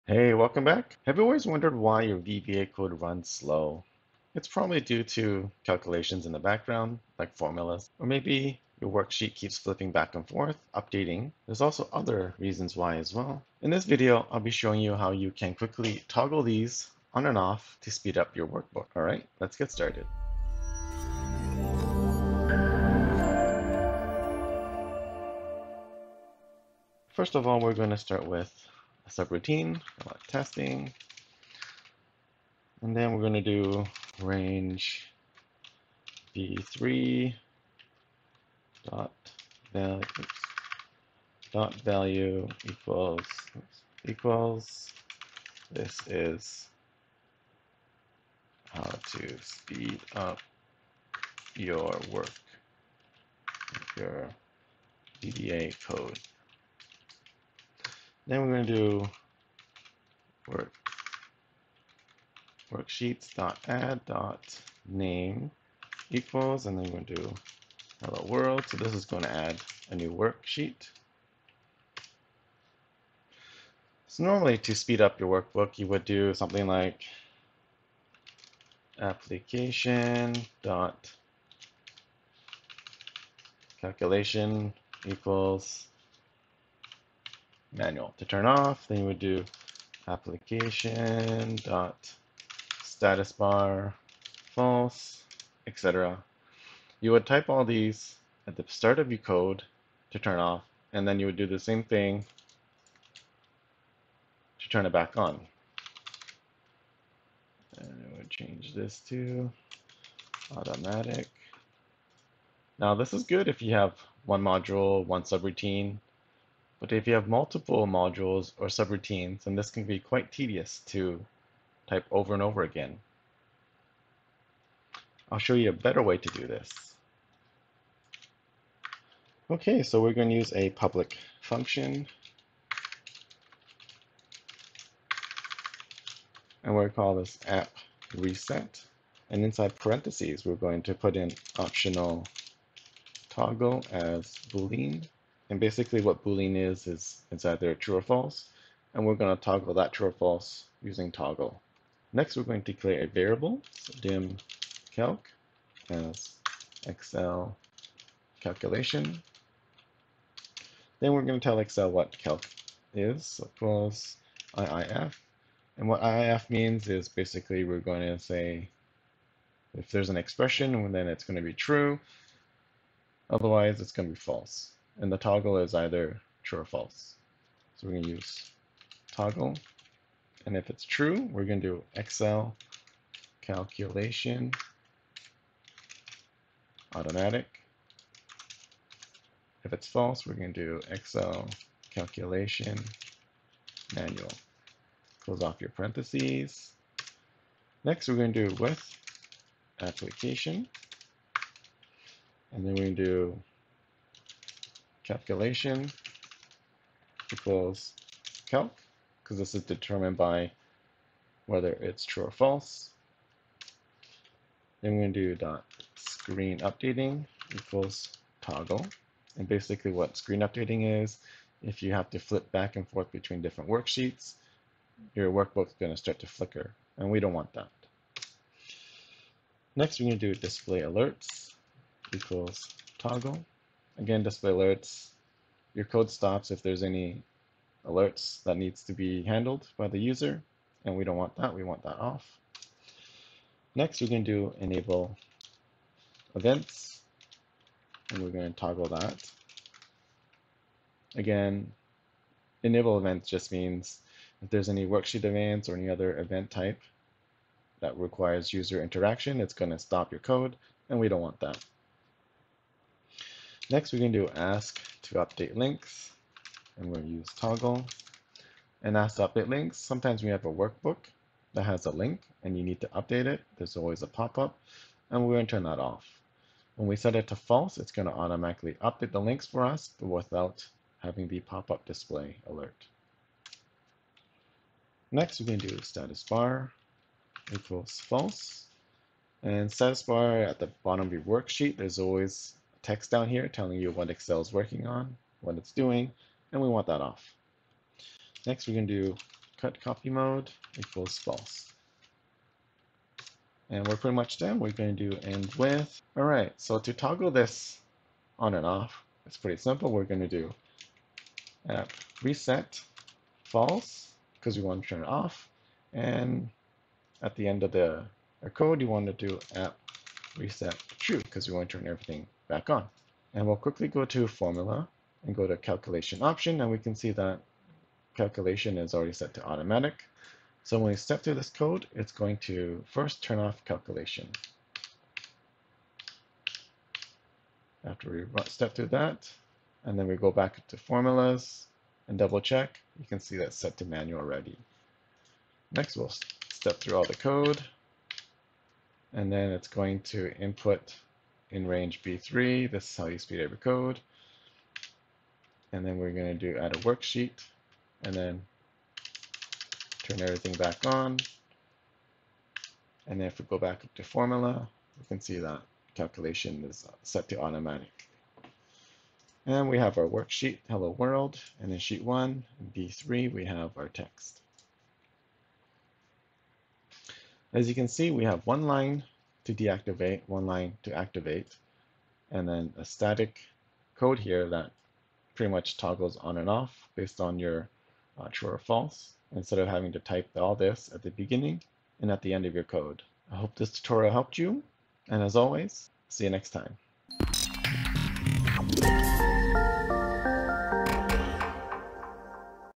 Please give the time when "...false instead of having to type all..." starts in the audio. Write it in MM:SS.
06:28.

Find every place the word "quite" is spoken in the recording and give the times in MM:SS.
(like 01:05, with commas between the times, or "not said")
01:59.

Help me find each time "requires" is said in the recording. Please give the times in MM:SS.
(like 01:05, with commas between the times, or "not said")
04:17.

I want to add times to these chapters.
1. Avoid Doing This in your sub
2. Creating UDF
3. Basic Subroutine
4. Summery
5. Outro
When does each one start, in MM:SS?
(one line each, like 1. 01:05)
1. 01:16
2. 02:09
3. 00:26
4. 06:16
5. 06:36.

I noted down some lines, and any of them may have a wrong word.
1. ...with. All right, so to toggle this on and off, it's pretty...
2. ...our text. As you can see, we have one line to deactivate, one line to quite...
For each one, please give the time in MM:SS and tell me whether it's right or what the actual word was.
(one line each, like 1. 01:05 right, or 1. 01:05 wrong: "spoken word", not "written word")
1. 05:05 right
2. 06:13 wrong: "activate", not "quite".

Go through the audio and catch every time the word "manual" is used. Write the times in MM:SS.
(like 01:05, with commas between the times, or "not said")
01:27, 03:13, 05:43.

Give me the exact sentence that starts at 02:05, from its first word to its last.
I'll show you a better way to do this.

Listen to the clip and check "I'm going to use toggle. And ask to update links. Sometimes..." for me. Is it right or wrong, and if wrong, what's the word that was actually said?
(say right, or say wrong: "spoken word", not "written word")
right.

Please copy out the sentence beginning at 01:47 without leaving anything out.
And I would change this to automatic.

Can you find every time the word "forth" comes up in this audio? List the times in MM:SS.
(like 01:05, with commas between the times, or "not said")
00:10, 03:42.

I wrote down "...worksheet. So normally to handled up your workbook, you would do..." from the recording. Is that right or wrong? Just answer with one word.
wrong.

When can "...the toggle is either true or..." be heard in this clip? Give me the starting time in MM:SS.
02:55.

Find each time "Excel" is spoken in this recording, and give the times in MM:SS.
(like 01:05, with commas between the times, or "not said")
02:36, 02:41, 03:01, 03:10, 04:54.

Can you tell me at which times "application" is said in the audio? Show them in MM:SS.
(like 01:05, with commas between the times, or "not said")
01:18, 01:30, 03:19.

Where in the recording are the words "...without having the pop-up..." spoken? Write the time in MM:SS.
04:40.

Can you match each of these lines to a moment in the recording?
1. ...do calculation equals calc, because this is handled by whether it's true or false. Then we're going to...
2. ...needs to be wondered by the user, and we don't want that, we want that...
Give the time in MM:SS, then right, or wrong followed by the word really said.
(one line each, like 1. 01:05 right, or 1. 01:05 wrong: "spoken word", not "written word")
1. 03:23 wrong: "determined", not "handled"
2. 03:58 wrong: "handled", not "wondered".